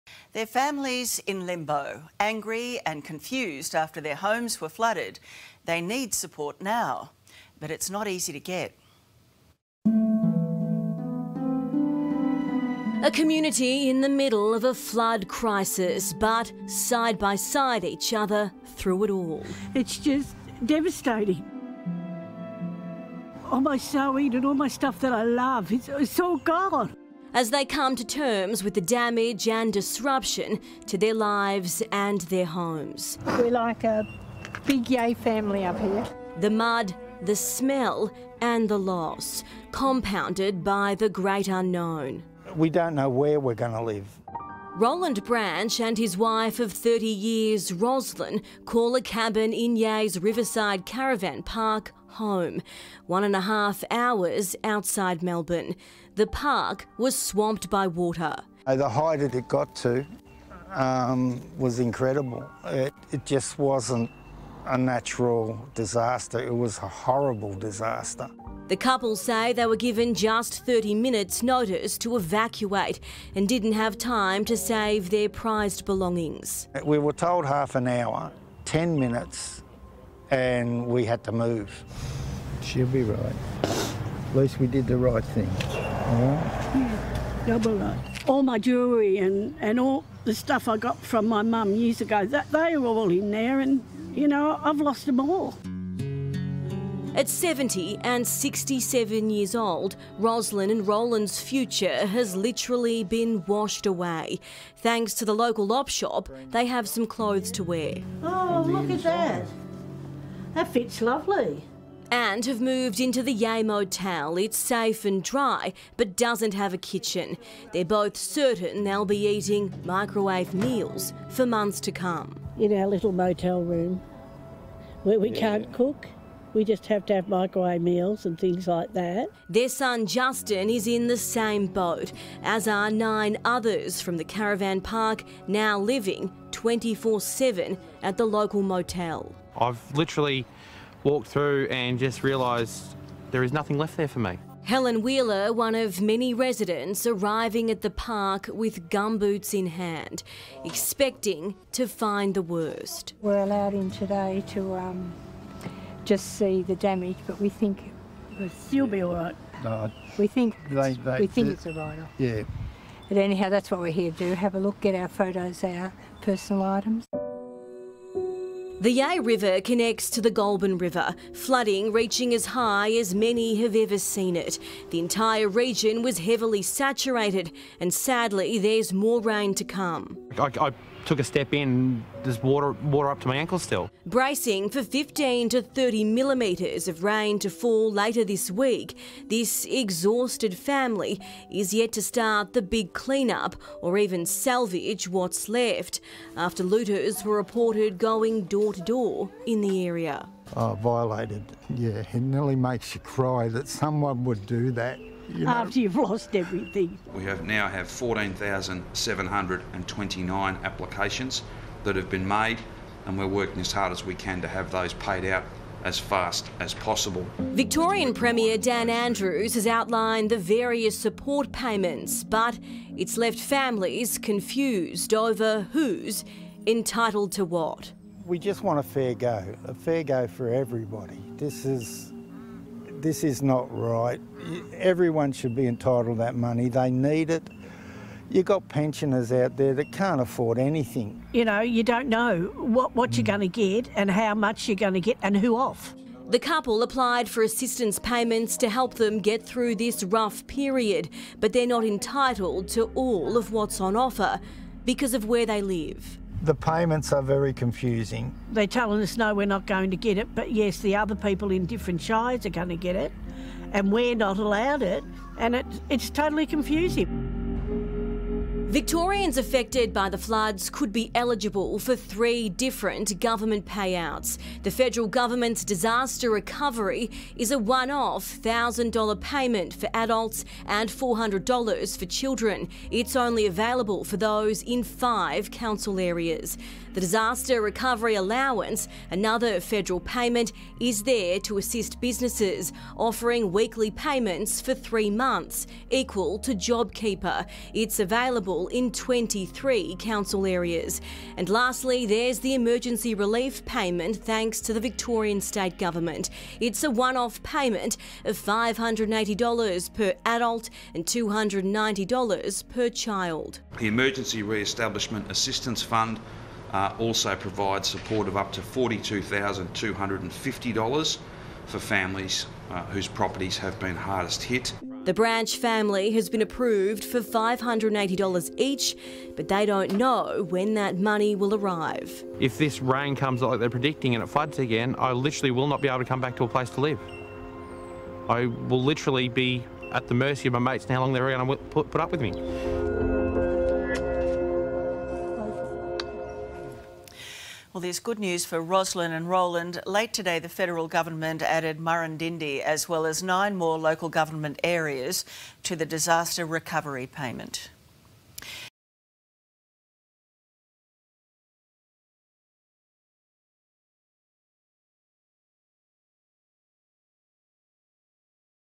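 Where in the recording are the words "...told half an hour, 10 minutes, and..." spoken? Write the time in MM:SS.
01:17.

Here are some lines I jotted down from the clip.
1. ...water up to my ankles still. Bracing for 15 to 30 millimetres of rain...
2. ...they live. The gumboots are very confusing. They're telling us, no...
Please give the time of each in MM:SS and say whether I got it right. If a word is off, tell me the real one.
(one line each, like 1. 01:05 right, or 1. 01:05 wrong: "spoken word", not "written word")
1. 03:02 right
2. 04:15 wrong: "payments", not "gumboots".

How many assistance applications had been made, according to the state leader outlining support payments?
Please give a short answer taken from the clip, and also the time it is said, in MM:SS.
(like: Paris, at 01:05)
14,729, at 03:27.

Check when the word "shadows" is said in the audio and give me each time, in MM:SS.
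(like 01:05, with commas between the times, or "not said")
not said.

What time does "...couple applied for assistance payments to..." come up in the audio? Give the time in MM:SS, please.
04:06.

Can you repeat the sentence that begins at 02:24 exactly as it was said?
Helen Wheeler, one of many residents arriving at the park with gumboots in hand, expecting to find the worst.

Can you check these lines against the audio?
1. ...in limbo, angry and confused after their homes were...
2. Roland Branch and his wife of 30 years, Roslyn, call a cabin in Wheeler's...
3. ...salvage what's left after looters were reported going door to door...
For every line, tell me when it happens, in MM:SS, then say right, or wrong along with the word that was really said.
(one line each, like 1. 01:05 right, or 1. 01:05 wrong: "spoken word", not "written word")
1. 00:01 right
2. 00:44 wrong: "Yea", not "Wheeler"
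3. 03:14 right.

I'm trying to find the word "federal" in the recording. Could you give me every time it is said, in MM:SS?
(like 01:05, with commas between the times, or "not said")
04:34, 04:49, 05:50.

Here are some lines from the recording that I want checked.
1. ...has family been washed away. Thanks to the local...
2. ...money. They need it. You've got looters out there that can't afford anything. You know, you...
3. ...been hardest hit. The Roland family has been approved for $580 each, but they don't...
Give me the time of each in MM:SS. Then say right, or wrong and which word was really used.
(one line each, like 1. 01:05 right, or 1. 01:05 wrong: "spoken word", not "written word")
1. 01:42 wrong: "literally", not "family"
2. 03:56 wrong: "pensioners", not "looters"
3. 05:23 wrong: "Branch", not "Roland".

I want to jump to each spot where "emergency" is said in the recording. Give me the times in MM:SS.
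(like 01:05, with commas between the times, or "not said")
05:02, 05:13.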